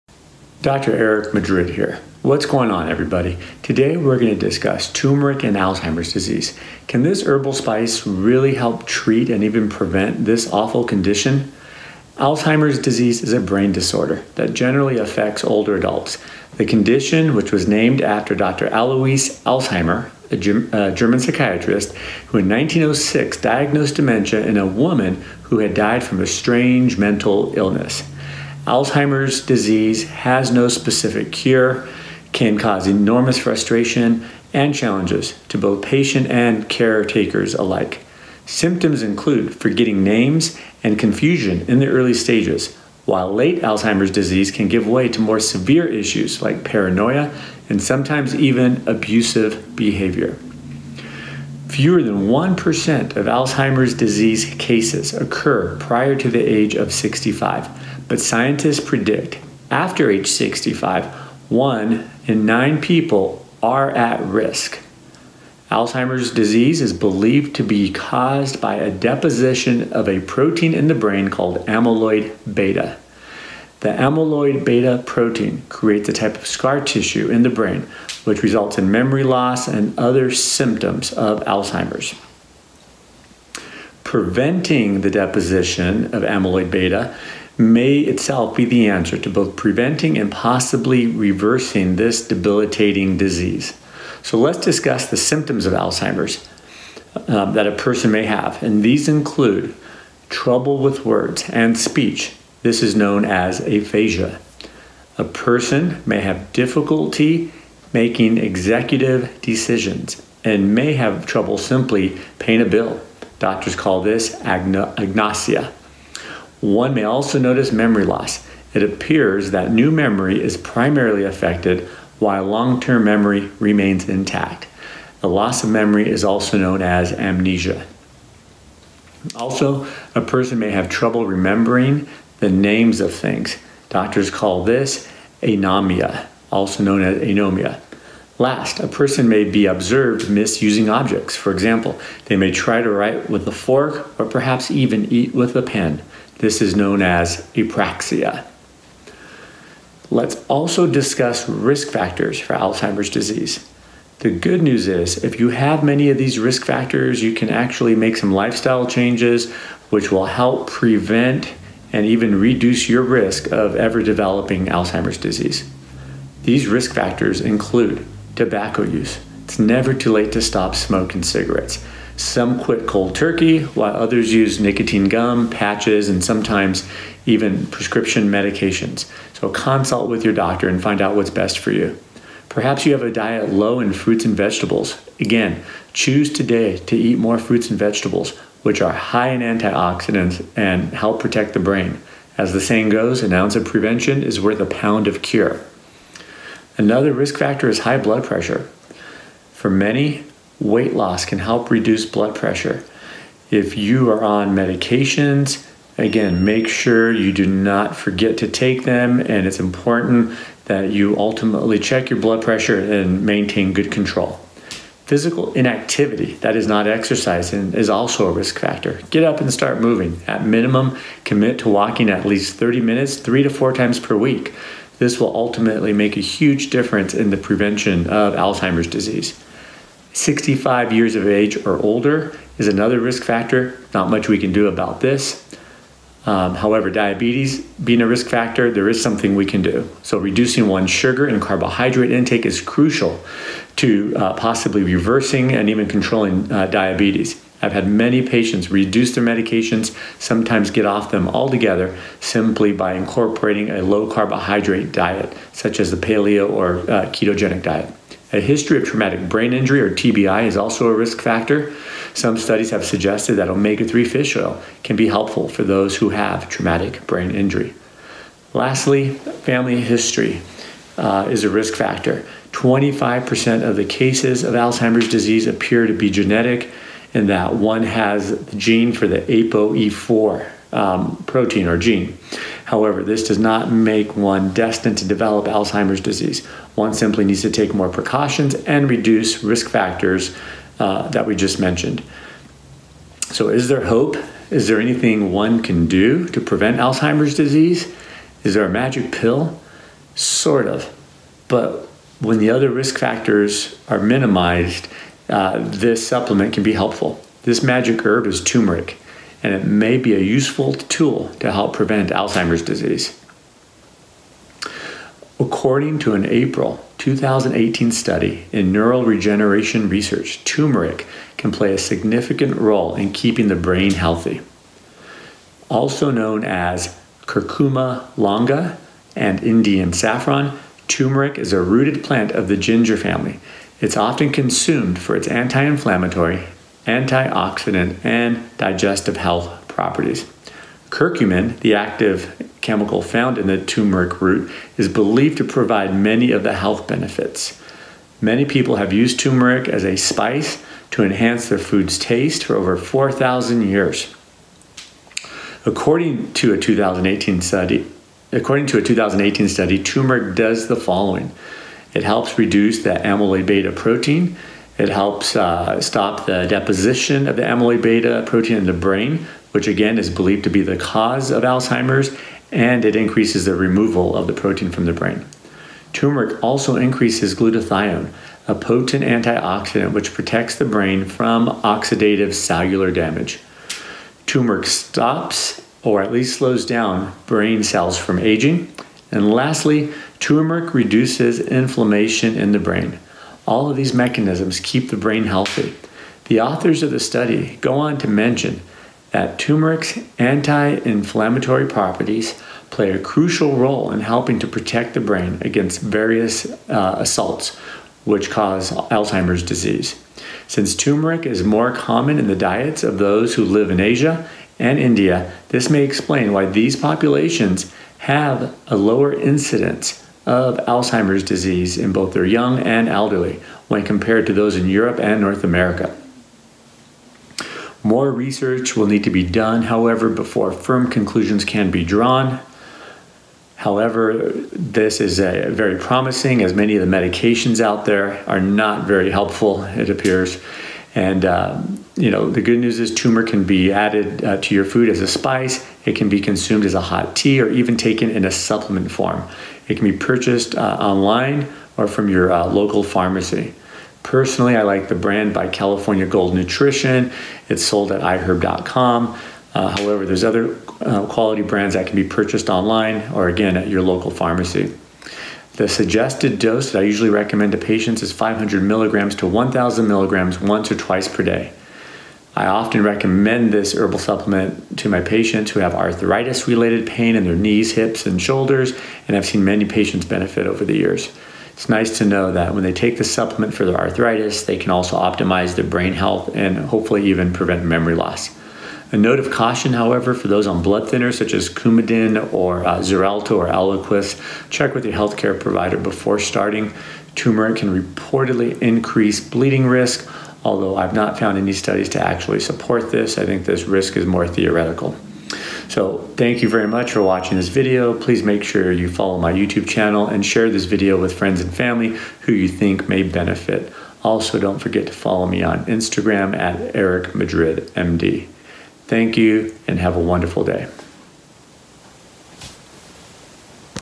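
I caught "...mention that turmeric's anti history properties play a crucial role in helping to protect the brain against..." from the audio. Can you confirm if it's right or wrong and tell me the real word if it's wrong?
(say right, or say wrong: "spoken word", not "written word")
wrong: "inflammatory", not "history".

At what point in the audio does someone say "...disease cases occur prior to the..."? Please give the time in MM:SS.
00:53.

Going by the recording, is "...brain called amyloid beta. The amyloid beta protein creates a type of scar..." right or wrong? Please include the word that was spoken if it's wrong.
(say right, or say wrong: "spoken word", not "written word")
right.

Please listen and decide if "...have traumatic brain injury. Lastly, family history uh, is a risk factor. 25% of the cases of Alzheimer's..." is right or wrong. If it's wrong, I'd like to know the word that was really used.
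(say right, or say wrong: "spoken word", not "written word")
right.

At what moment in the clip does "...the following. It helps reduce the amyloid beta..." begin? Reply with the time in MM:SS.
06:00.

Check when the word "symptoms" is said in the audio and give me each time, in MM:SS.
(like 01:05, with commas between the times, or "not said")
00:38, 01:20, 01:35.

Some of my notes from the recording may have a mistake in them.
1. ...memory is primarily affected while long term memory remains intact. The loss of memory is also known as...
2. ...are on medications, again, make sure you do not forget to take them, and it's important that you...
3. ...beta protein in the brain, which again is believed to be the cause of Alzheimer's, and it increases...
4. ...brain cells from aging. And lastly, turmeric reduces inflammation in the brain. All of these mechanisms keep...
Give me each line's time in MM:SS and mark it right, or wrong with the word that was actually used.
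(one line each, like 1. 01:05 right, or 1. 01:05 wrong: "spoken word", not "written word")
1. 01:59 right
2. 03:24 right
3. 06:07 right
4. 06:27 right.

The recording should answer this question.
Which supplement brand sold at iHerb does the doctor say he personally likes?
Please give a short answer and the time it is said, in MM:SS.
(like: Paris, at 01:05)
California Gold Nutrition, at 07:35.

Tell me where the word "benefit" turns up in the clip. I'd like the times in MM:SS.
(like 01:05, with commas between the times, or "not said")
05:46, 08:00, 08:33.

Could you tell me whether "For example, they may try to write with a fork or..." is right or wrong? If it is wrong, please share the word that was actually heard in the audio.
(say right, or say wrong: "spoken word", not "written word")
right.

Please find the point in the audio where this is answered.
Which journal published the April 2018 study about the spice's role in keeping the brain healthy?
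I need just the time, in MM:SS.
05:18.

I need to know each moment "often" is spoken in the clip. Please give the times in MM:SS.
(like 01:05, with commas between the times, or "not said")
05:33, 07:52.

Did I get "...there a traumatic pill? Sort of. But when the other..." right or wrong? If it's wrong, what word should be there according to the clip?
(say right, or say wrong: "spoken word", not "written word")
wrong: "magic", not "traumatic".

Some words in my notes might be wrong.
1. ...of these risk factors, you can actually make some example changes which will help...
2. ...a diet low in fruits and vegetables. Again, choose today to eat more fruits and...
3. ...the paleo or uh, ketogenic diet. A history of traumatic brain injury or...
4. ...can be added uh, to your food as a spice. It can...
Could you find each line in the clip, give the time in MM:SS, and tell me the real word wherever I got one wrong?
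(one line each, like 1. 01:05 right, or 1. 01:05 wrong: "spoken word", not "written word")
1. 02:36 wrong: "lifestyle", not "example"
2. 03:03 right
3. 04:15 right
4. 07:23 right.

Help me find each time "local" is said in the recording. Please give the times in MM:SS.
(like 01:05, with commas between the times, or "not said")
07:32, 07:43.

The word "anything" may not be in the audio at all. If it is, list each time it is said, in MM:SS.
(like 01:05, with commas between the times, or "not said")
04:54.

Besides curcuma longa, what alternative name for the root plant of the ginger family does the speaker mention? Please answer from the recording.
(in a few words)
Indian saffron.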